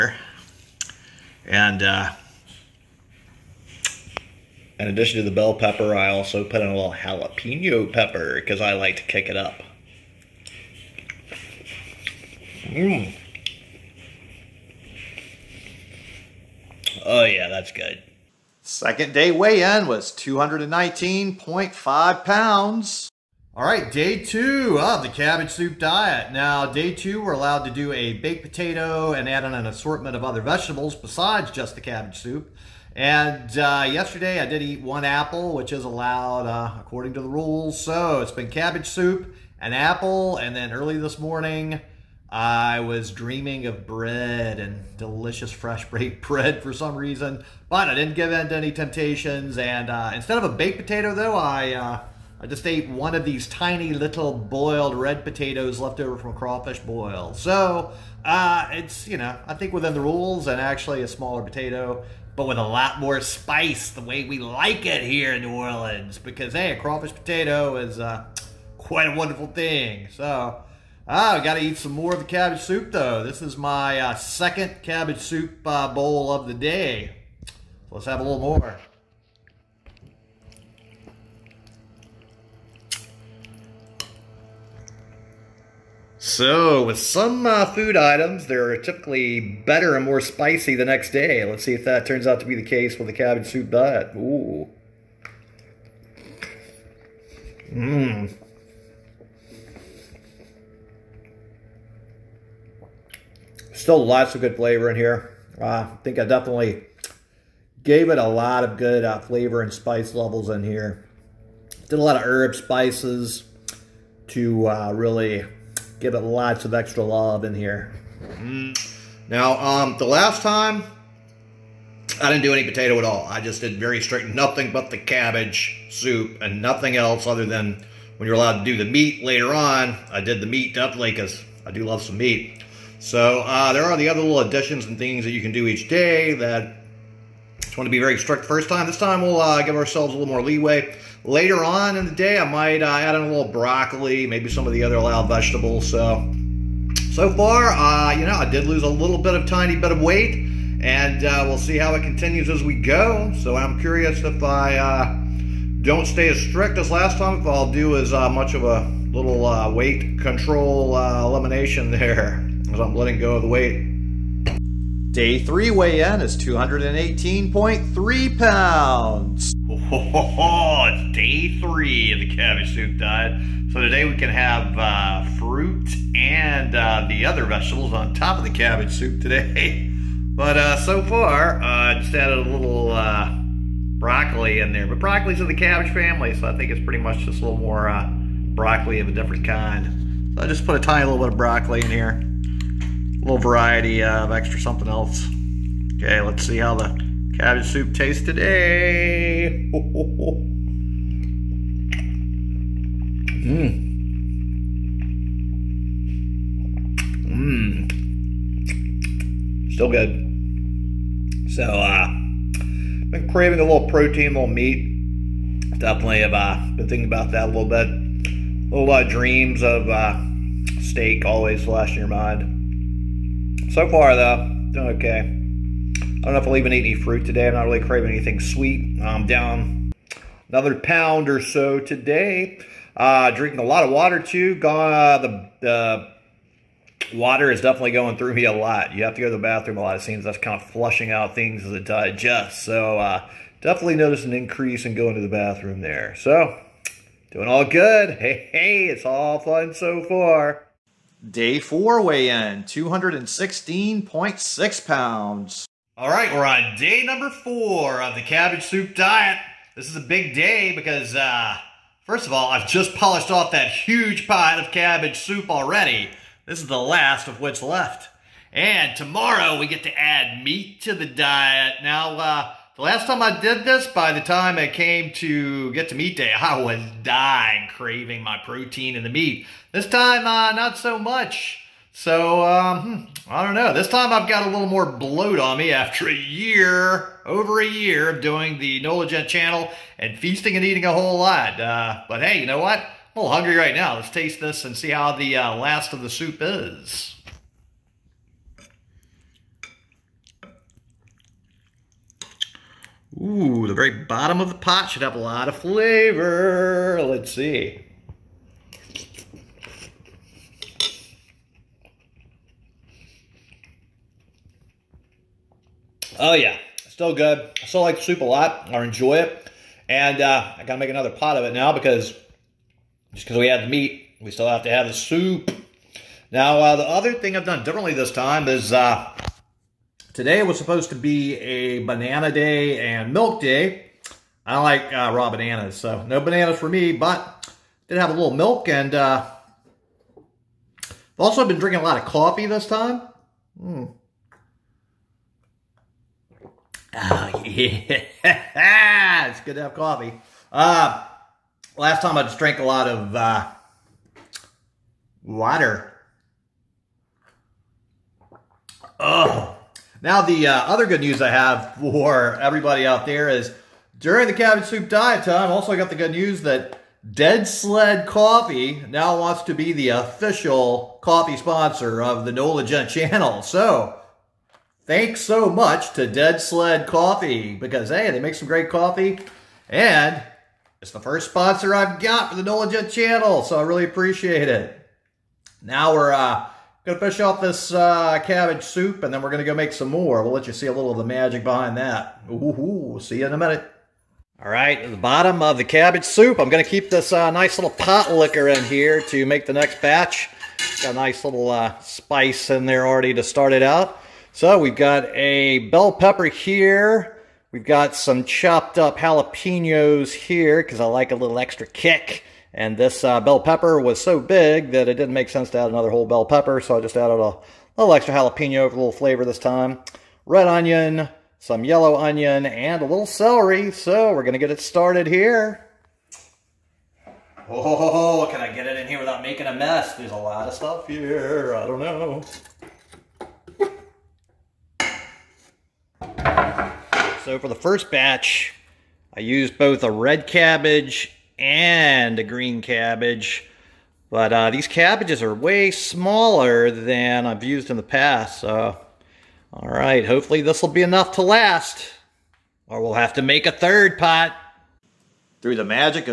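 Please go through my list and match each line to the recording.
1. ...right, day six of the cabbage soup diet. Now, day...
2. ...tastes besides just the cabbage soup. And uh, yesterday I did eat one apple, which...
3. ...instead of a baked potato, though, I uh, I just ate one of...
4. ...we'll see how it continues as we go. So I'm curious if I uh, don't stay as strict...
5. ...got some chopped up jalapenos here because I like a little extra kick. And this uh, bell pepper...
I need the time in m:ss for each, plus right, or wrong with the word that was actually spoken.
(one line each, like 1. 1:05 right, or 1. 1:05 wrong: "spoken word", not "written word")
1. 0:23 wrong: "two", not "six"
2. 0:30 wrong: "vegetables", not "tastes"
3. 0:50 right
4. 2:31 right
5. 6:47 right.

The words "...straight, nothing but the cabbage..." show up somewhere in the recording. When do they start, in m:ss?
2:04.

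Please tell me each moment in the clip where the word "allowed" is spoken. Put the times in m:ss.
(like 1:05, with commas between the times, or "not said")
0:27, 0:35, 2:08, 2:24.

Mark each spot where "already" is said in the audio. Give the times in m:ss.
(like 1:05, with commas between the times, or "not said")
4:25, 6:42.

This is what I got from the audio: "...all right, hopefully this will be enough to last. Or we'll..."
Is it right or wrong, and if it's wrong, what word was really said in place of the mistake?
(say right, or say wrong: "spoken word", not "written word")
right.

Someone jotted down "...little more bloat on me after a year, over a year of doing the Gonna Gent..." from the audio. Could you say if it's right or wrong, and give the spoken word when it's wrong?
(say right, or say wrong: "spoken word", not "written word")
wrong: "NOLA", not "Gonna".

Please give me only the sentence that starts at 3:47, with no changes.
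I'm not really craving anything sweet.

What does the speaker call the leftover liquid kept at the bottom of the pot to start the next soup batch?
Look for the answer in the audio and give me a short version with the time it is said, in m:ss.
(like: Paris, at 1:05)
pot liquor, at 6:37.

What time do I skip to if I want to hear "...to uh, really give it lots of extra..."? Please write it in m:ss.
1:54.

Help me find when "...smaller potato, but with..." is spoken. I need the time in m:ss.
1:01.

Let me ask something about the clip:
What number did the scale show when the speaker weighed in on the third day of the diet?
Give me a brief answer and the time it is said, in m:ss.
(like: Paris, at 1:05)
218.3 pounds, at 2:46.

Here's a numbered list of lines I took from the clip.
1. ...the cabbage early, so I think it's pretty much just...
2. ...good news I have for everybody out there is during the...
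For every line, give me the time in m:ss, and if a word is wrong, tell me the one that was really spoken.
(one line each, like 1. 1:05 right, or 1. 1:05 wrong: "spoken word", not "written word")
1. 3:05 wrong: "family", not "early"
2. 6:00 right.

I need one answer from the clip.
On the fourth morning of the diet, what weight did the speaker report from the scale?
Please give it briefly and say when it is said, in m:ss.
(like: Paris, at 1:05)
216.6 pounds, at 4:12.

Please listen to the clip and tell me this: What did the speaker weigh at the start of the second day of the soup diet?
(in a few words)
219.5 pounds.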